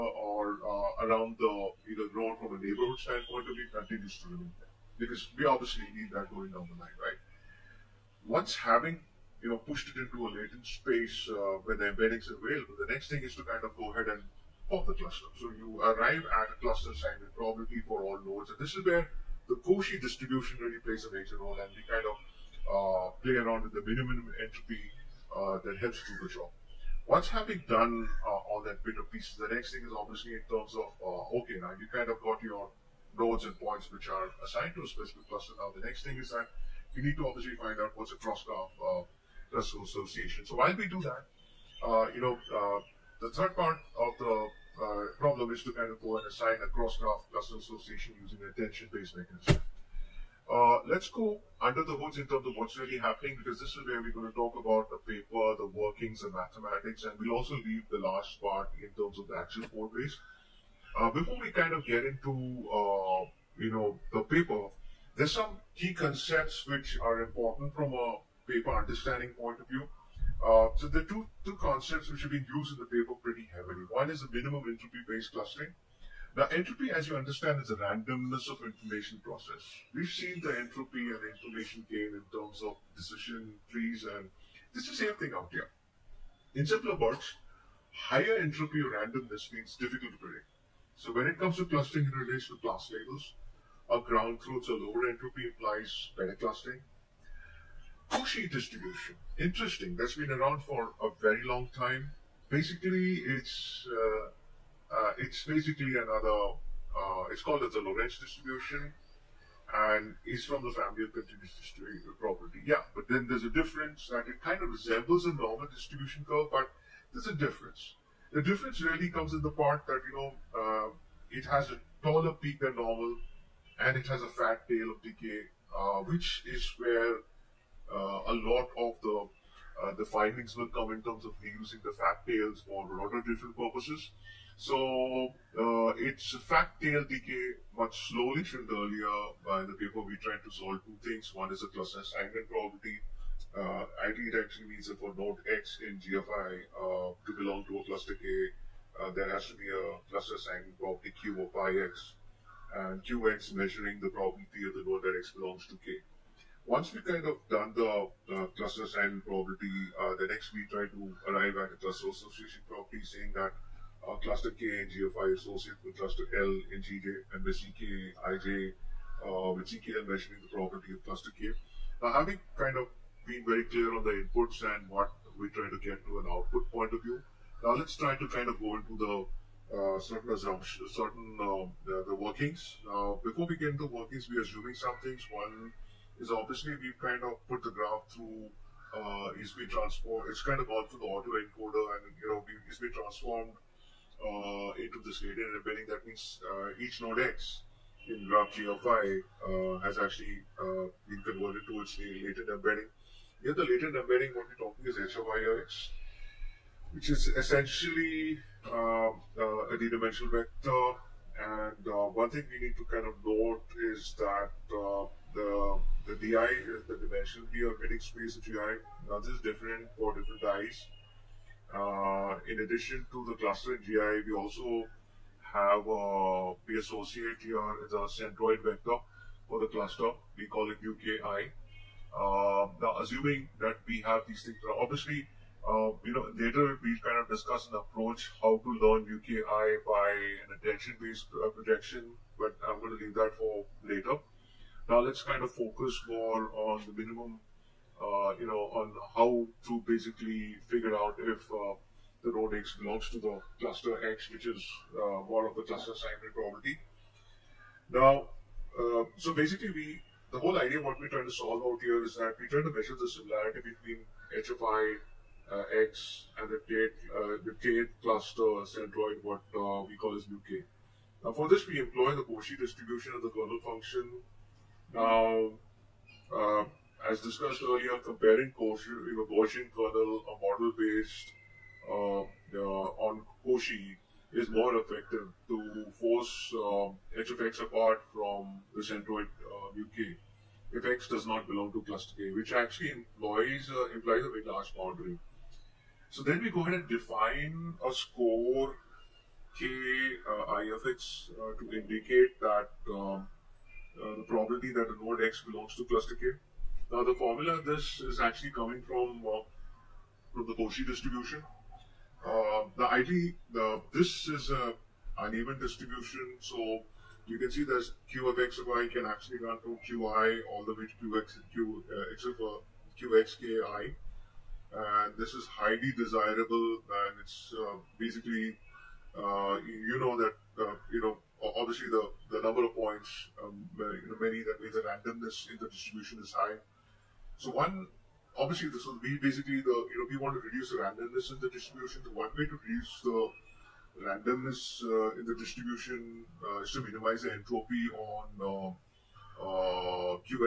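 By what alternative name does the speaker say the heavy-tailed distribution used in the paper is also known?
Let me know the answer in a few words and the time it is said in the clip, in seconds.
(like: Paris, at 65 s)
Lorentz distribution, at 107 s.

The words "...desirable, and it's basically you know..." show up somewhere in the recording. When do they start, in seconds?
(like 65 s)
325 s.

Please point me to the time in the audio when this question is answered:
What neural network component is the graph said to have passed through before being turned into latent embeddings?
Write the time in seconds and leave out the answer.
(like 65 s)
191 s.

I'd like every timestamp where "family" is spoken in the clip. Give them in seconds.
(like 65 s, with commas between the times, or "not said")
110 s.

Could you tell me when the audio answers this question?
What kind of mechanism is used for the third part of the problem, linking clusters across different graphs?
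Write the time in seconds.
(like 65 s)
48 s.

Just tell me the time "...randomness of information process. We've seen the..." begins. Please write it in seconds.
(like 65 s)
77 s.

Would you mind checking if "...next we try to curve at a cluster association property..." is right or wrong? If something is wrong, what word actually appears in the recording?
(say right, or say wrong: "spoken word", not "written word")
wrong: "arrive", not "curve".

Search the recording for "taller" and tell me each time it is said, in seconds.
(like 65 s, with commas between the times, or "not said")
122 s.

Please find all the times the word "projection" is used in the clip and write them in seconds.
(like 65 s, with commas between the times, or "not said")
241 s.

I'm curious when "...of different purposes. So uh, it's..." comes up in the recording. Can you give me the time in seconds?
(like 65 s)
133 s.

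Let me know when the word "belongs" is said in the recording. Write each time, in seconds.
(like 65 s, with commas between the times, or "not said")
147 s, 155 s, 252 s, 291 s, 305 s.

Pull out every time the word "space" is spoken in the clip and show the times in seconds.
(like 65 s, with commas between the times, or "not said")
10 s, 218 s.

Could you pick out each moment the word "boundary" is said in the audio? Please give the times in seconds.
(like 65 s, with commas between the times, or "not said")
294 s.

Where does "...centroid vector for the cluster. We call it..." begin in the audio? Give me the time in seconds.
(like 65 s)
228 s.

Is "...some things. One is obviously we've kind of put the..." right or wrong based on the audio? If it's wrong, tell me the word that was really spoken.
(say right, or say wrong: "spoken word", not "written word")
right.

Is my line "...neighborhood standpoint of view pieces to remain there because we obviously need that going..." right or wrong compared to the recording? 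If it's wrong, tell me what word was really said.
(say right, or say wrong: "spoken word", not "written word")
wrong: "continues", not "pieces".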